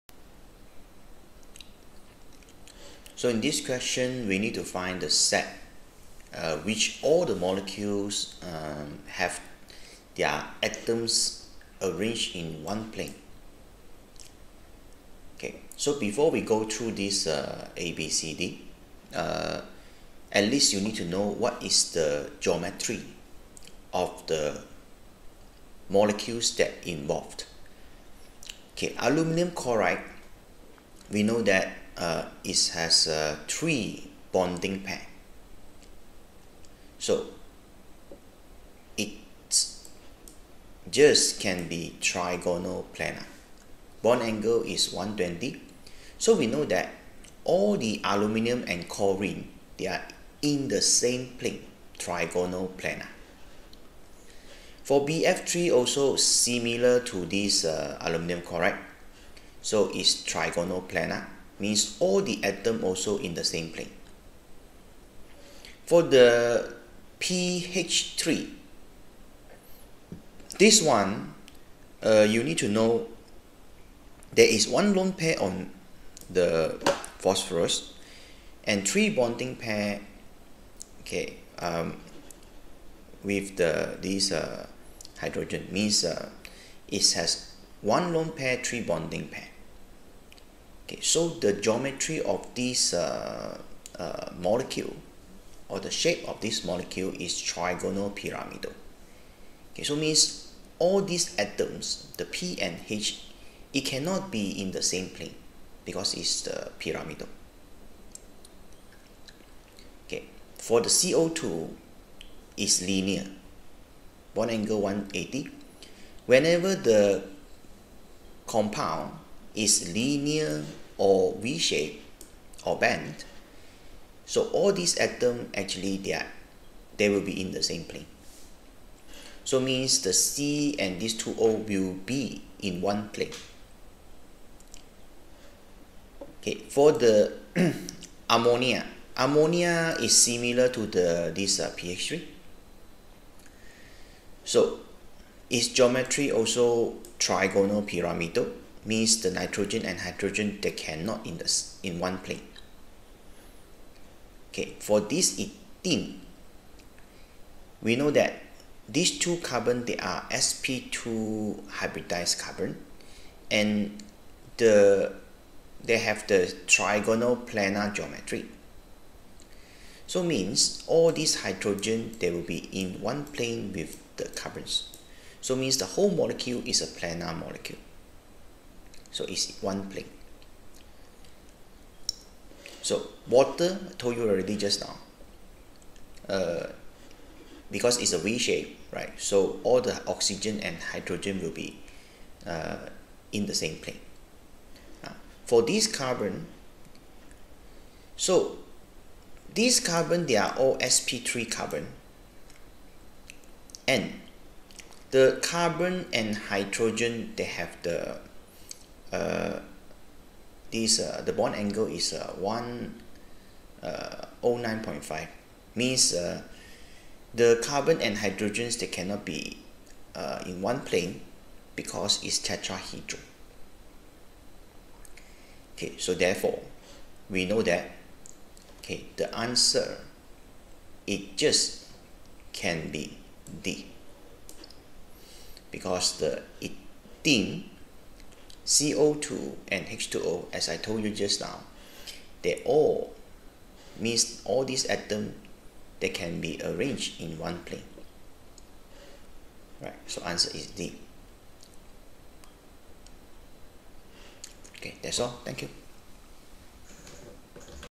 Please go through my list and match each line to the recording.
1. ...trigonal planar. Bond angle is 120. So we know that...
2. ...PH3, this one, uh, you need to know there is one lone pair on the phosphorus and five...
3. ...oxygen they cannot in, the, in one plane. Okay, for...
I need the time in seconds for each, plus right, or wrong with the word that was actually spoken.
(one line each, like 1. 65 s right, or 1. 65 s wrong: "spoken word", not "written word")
1. 41 s right
2. 67 s wrong: "three", not "five"
3. 149 s wrong: "hydrogen", not "oxygen".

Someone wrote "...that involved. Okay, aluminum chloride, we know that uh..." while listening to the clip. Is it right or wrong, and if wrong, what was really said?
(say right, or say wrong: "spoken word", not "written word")
right.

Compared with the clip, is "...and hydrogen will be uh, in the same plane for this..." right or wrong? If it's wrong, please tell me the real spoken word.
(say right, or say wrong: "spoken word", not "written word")
right.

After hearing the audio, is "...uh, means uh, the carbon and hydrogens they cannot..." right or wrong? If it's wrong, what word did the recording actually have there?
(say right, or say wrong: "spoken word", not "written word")
right.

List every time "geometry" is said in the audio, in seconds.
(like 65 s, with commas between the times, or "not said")
22 s, 91 s, 145 s, 167 s.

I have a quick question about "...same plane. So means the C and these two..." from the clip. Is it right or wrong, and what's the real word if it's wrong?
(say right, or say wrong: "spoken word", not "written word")
right.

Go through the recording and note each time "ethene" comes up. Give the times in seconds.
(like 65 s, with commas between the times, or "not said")
155 s, 236 s.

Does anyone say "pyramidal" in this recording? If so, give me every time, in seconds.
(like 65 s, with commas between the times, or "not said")
98 s, 106 s, 147 s.